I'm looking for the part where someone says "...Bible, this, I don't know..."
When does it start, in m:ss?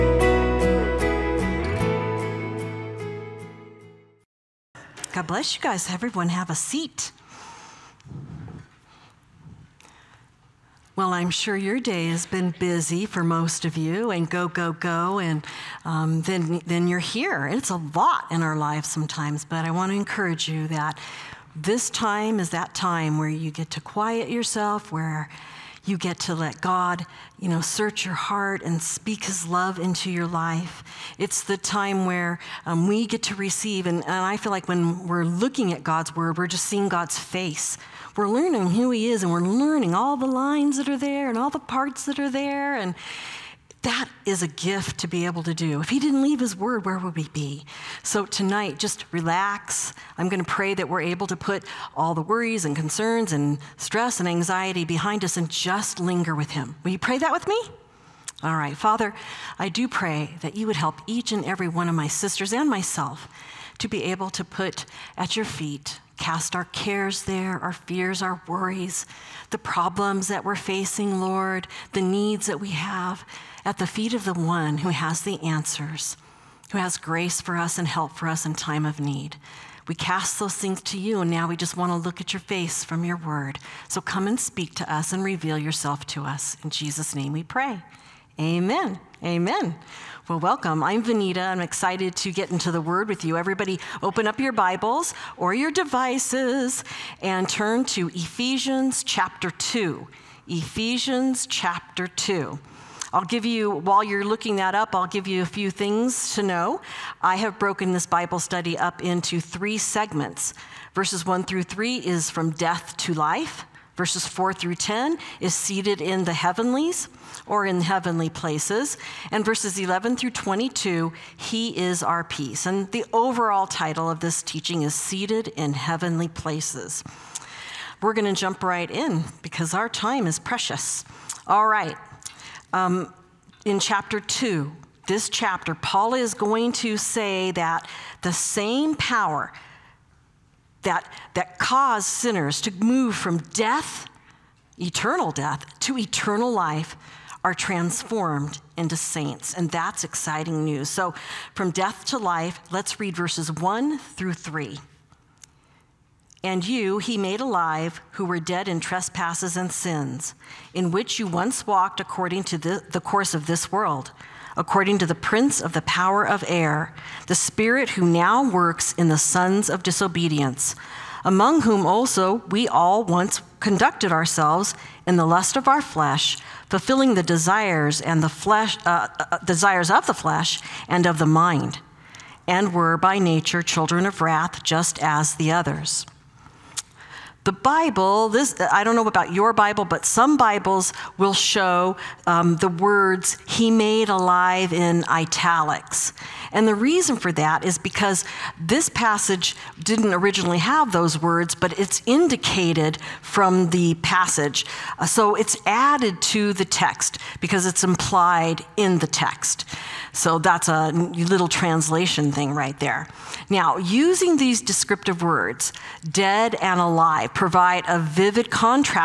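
3:07.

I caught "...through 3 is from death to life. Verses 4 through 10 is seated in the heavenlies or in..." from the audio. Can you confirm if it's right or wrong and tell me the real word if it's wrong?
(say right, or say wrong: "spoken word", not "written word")
right.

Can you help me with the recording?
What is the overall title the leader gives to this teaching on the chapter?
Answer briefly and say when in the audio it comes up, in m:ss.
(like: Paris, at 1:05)
Seated in Heavenly Places, at 2:04.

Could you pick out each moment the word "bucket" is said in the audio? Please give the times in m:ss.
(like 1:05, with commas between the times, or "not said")
not said.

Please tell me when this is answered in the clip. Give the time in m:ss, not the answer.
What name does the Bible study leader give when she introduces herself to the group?
1:31.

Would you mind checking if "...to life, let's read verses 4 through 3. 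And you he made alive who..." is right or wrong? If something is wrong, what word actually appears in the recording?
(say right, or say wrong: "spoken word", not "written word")
wrong: "1", not "4".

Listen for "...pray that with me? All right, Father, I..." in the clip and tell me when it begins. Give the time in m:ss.
0:56.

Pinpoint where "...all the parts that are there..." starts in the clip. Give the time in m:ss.
0:41.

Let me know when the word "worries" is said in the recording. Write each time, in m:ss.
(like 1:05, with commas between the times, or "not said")
0:52, 1:08.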